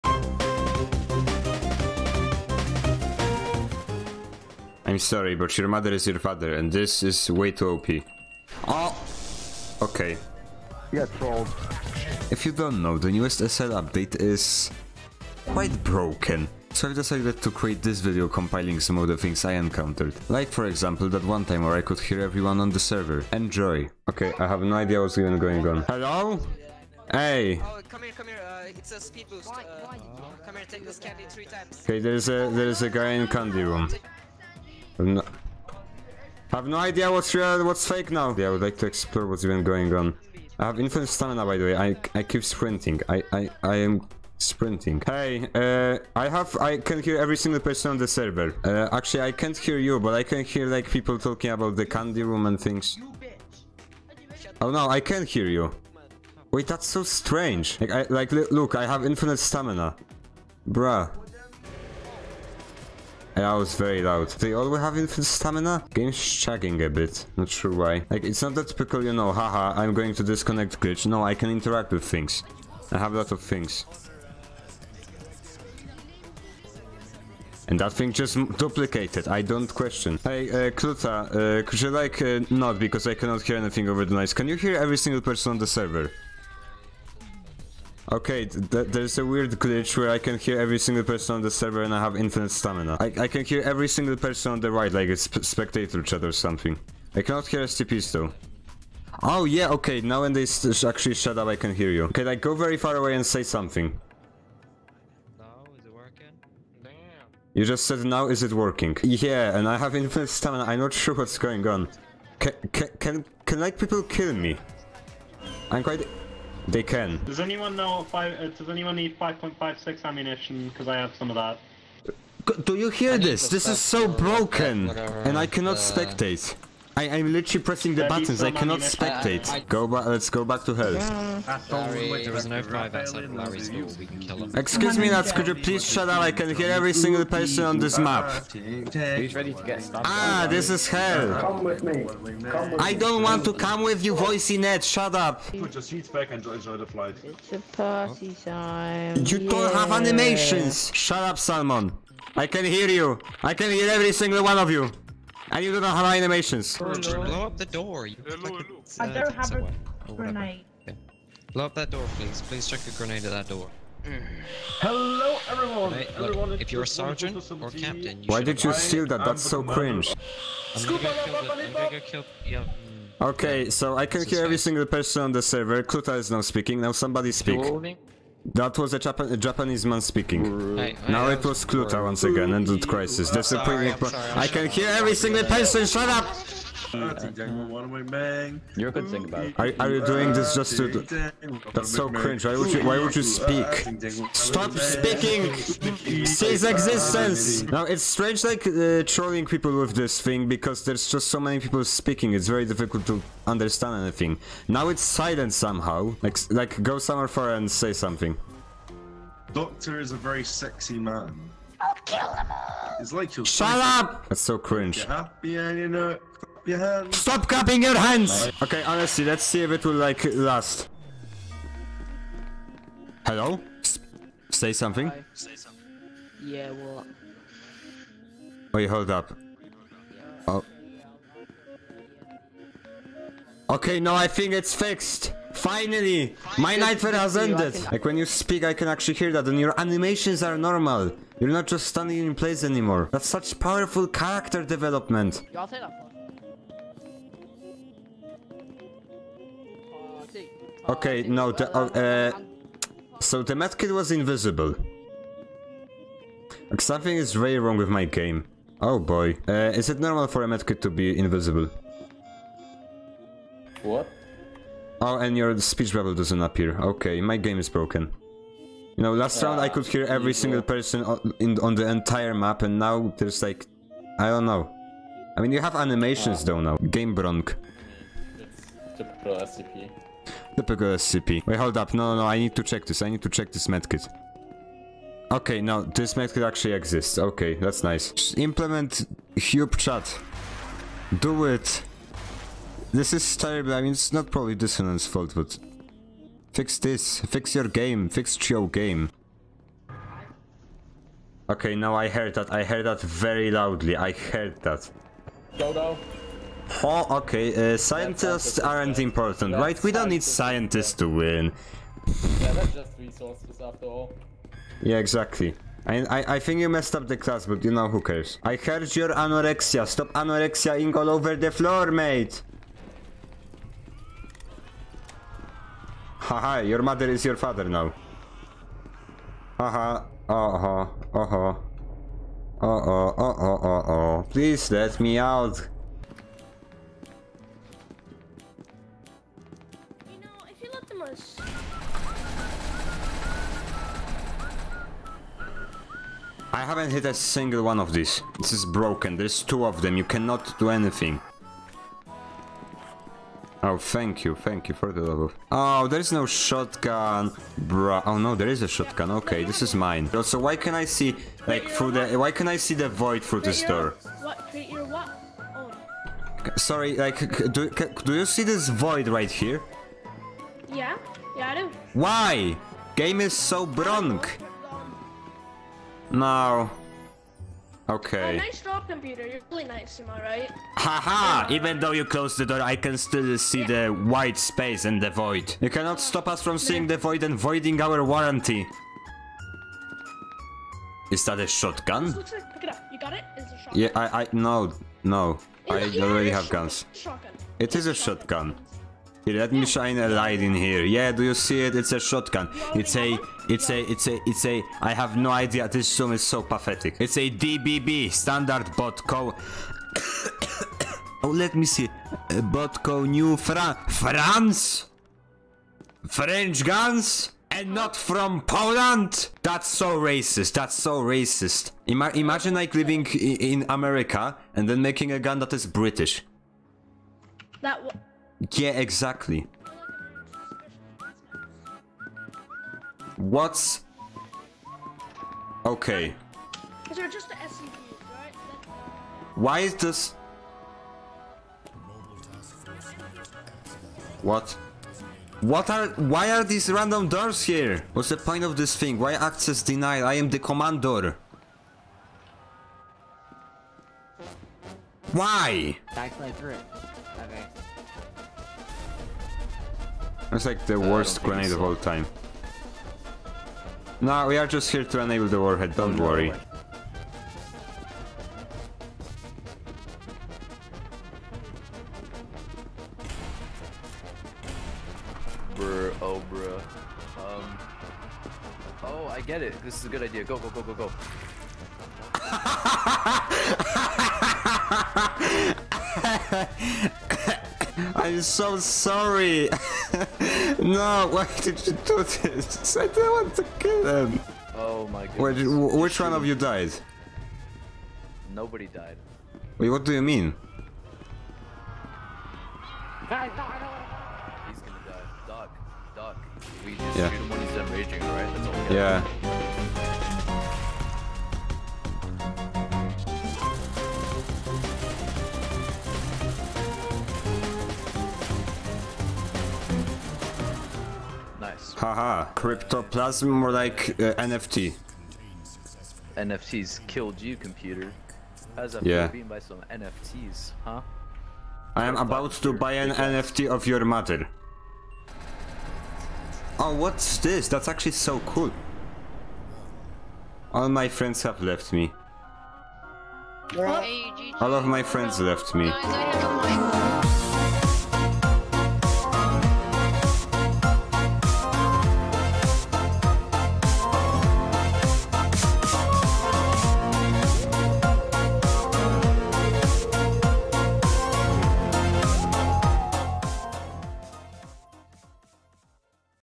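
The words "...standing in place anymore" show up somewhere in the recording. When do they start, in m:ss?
4:01.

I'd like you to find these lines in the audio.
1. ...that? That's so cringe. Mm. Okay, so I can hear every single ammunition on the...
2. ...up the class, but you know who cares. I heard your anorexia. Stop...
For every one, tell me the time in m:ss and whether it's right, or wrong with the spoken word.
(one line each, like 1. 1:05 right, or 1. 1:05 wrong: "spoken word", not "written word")
1. 2:49 wrong: "person", not "ammunition"
2. 5:16 right.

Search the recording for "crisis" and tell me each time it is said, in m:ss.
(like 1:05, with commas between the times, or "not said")
3:02.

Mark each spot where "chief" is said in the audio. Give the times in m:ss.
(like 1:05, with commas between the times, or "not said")
not said.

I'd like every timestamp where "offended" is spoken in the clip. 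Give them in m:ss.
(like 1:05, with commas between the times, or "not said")
not said.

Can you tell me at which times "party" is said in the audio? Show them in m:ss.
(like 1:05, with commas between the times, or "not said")
2:27.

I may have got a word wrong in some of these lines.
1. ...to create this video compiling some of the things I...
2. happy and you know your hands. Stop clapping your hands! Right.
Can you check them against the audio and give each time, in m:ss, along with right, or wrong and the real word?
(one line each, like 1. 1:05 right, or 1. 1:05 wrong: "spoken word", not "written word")
1. 0:17 right
2. 3:35 right.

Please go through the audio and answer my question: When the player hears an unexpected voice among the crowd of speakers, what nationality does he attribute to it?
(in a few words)
Japanese.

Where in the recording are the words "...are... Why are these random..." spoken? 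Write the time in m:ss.
7:25.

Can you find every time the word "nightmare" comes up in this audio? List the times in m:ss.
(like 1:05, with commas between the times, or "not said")
3:56.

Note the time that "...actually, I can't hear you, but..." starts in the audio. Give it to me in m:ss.
0:48.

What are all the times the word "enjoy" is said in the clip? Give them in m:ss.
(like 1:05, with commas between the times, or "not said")
0:23, 2:26.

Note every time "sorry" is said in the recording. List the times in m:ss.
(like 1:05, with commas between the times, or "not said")
0:04, 6:06, 8:08.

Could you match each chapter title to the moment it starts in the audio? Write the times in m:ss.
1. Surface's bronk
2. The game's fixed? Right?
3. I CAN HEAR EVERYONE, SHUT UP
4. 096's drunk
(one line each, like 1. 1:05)
1. 5:36
2. 3:41
3. 0:24
4. 7:35.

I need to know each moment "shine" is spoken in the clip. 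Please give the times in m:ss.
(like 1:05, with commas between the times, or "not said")
6:39.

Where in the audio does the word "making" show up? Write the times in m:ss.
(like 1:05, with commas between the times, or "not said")
7:04.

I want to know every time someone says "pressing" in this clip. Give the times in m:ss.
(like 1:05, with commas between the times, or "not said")
2:07.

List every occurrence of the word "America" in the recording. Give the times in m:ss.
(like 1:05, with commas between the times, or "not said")
7:03.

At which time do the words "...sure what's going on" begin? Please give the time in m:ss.
1:50.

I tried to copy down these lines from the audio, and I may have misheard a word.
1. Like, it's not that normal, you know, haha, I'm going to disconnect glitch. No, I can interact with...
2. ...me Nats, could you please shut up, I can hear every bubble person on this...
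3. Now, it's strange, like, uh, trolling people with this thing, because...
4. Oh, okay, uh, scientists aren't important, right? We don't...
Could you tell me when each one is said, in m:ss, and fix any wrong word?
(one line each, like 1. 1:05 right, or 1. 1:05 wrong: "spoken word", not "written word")
1. 1:08 wrong: "typical", not "normal"
2. 2:14 wrong: "single", not "bubble"
3. 3:17 right
4. 5:06 right.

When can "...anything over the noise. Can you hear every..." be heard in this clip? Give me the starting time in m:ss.
1:23.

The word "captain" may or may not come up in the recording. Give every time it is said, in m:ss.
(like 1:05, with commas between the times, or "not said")
2:47.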